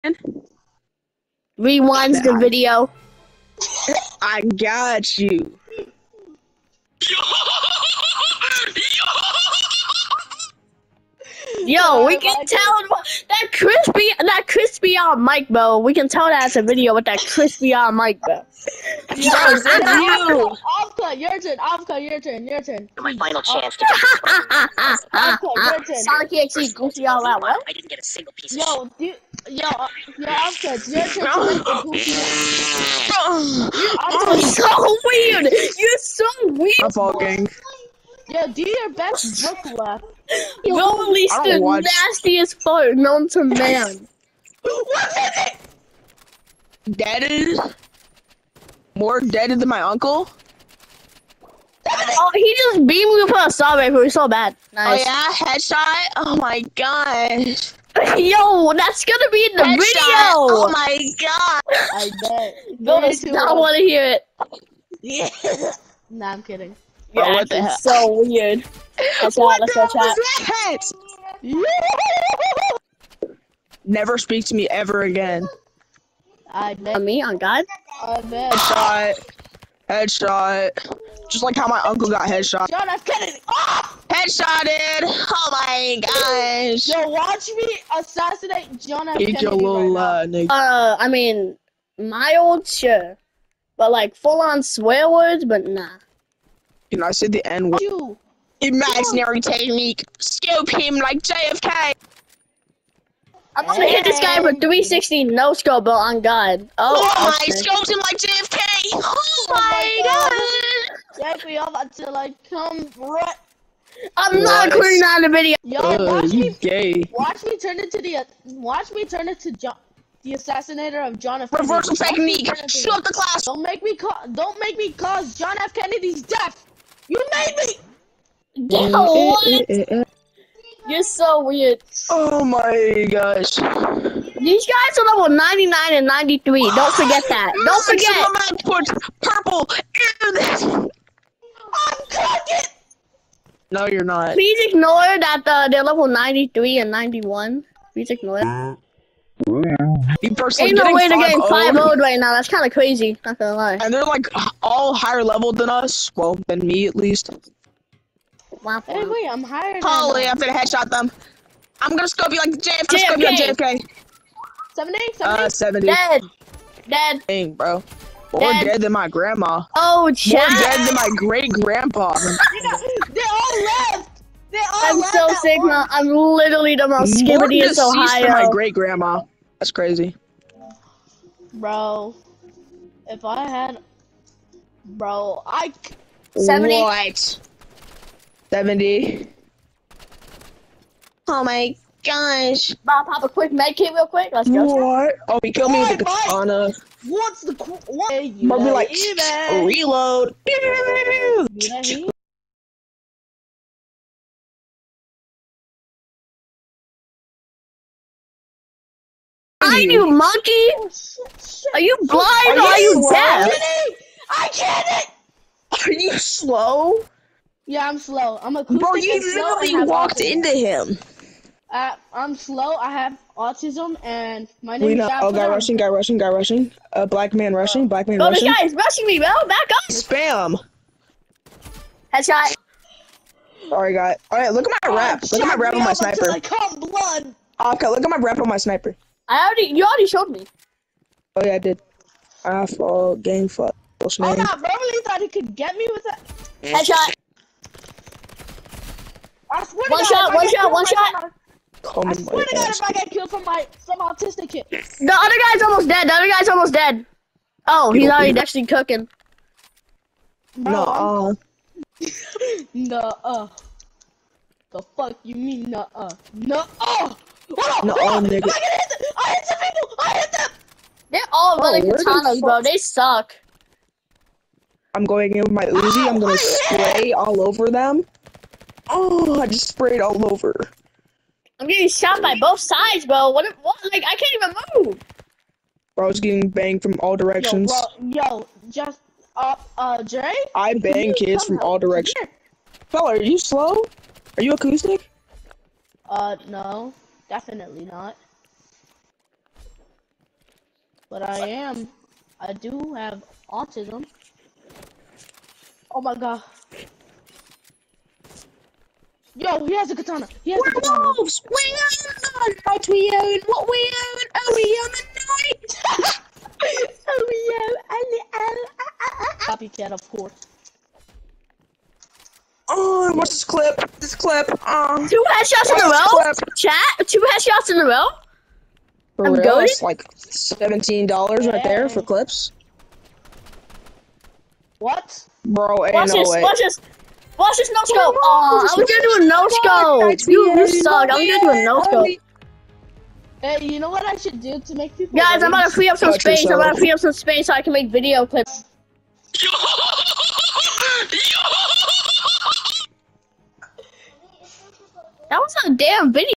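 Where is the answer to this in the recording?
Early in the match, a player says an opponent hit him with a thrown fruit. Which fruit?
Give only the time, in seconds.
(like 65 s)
53 s.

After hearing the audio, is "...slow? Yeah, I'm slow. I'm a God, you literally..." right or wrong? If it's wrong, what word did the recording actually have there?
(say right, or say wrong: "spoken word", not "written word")
wrong: "Bro", not "God".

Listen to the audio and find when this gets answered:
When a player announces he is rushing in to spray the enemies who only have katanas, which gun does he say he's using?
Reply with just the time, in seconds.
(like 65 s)
275 s.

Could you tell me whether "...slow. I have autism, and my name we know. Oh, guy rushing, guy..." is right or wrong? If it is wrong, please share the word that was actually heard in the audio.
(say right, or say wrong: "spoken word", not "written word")
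right.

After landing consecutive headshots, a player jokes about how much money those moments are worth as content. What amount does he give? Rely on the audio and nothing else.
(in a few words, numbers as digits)
$17.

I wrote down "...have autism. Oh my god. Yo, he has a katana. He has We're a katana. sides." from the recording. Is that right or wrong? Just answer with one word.
wrong.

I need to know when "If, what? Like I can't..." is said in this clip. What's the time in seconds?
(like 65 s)
283 s.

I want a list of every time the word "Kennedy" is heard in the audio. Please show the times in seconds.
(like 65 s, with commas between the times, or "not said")
83 s, 89 s, 125 s.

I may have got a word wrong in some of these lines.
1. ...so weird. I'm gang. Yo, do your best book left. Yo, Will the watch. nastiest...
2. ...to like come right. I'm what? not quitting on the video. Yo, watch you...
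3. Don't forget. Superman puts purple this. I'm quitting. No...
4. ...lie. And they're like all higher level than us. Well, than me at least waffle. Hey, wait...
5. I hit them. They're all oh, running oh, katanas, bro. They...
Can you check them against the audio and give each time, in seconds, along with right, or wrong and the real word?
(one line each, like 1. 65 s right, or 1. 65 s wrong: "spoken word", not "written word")
1. 35 s right
2. 111 s right
3. 137 s wrong: "cooking", not "quitting"
4. 153 s right
5. 269 s right.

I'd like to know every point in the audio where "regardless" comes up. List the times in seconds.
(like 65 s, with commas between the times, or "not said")
not said.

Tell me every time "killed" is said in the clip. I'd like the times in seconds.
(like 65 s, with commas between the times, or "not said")
195 s, 253 s.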